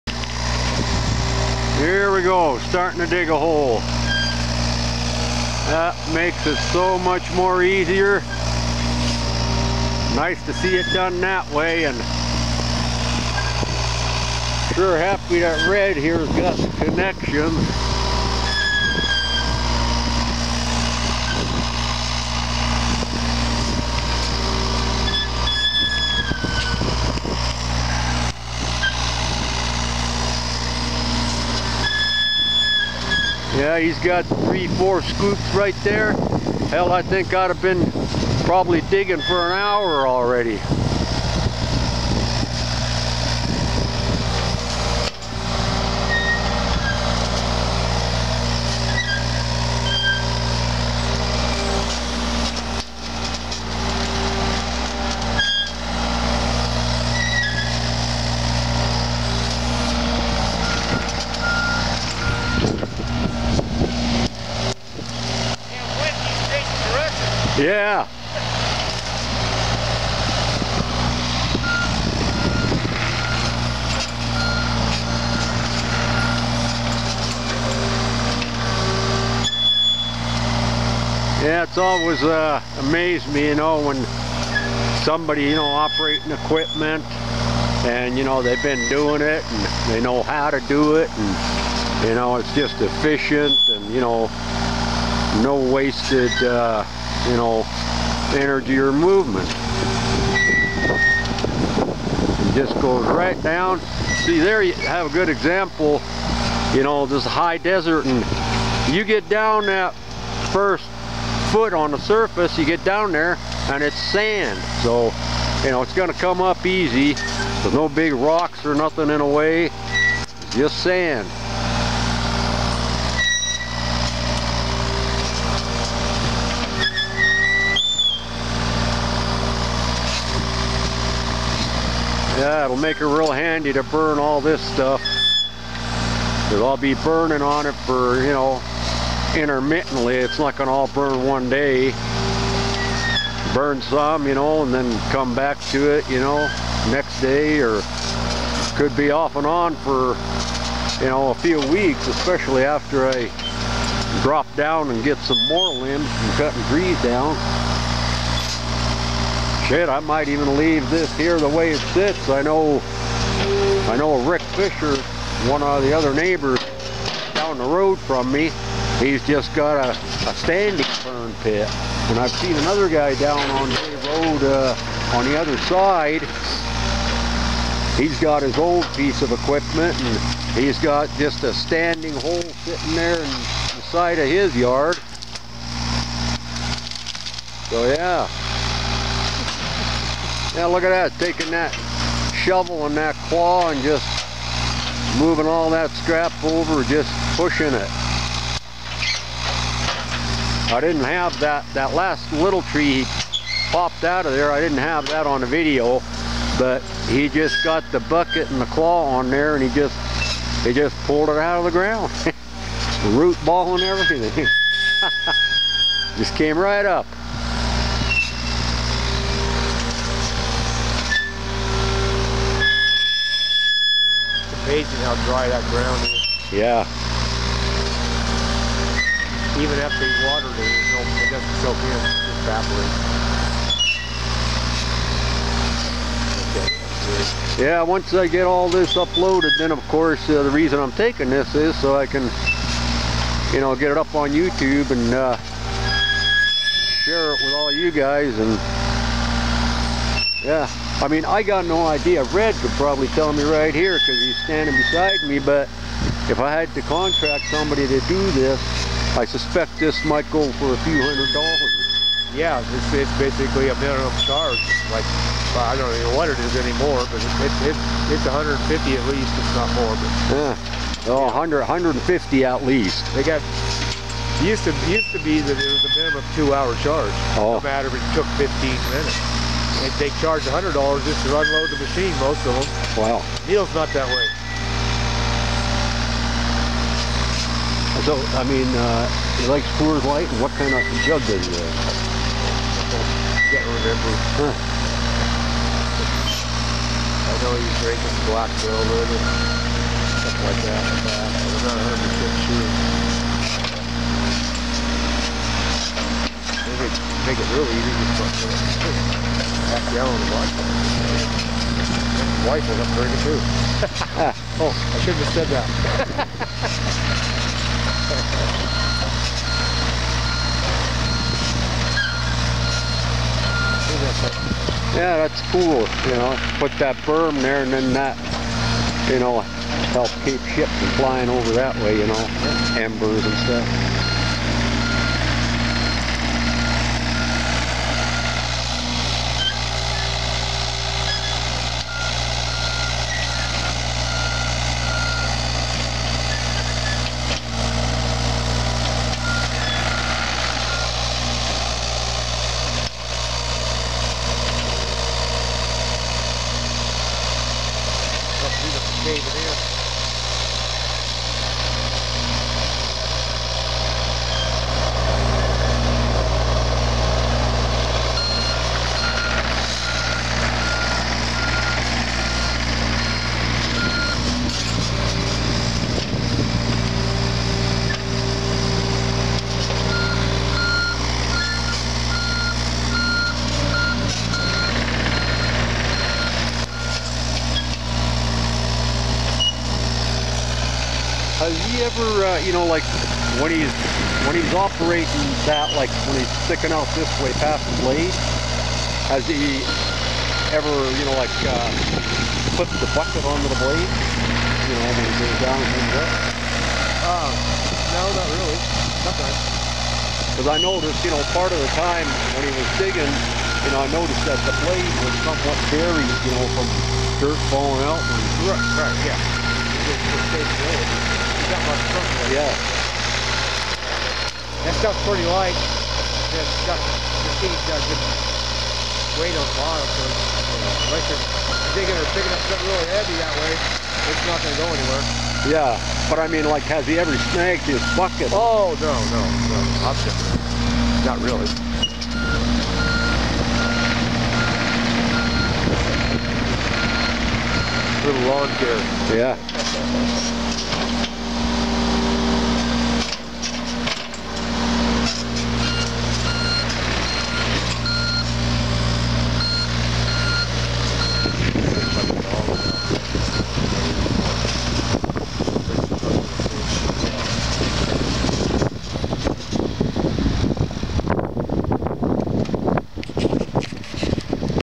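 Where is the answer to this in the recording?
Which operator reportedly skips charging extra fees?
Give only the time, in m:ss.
4:43.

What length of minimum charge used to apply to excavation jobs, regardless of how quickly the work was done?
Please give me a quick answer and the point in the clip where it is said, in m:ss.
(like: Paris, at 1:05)
2 hours, at 4:35.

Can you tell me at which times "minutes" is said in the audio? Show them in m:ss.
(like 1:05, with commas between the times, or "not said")
4:38.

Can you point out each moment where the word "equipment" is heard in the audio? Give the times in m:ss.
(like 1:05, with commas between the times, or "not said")
1:26, 2:59.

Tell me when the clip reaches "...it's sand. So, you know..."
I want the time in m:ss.
1:53.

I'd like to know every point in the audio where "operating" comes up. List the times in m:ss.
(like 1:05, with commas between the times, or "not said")
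1:25, 6:34.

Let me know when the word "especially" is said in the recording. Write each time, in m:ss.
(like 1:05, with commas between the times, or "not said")
2:32.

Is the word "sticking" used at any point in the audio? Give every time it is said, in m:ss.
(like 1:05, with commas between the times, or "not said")
6:36.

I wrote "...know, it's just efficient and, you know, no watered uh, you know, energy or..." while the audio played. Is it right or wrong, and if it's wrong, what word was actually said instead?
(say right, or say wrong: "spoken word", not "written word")
wrong: "wasted", not "watered".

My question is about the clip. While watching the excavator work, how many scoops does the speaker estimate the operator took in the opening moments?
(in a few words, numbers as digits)
3 or 4.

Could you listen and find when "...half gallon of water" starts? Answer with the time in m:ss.
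5:09.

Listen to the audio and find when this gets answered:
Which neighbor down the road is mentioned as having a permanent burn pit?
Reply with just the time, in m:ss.
2:44.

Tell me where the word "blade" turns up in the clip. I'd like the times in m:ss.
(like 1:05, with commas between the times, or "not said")
6:37, 6:43, 6:54.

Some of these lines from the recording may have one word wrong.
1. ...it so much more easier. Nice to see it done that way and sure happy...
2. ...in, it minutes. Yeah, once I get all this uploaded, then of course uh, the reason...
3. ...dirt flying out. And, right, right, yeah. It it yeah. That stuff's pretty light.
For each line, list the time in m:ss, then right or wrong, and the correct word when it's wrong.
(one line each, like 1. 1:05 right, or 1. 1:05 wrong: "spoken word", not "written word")
1. 0:06 right
2. 3:51 wrong: "evaporates", not "minutes"
3. 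6:57 wrong: "falling", not "flying".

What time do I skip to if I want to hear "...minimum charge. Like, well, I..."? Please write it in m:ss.
4:23.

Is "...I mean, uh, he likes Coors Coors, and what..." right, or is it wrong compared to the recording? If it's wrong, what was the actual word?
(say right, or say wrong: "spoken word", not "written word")
wrong: "Light", not "Coors".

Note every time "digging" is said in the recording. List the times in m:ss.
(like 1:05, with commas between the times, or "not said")
0:38, 6:52, 7:11.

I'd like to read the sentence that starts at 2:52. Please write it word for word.
And I've seen another guy down on the Road uh, on the other side.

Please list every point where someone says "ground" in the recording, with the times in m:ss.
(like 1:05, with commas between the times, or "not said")
3:31, 3:45.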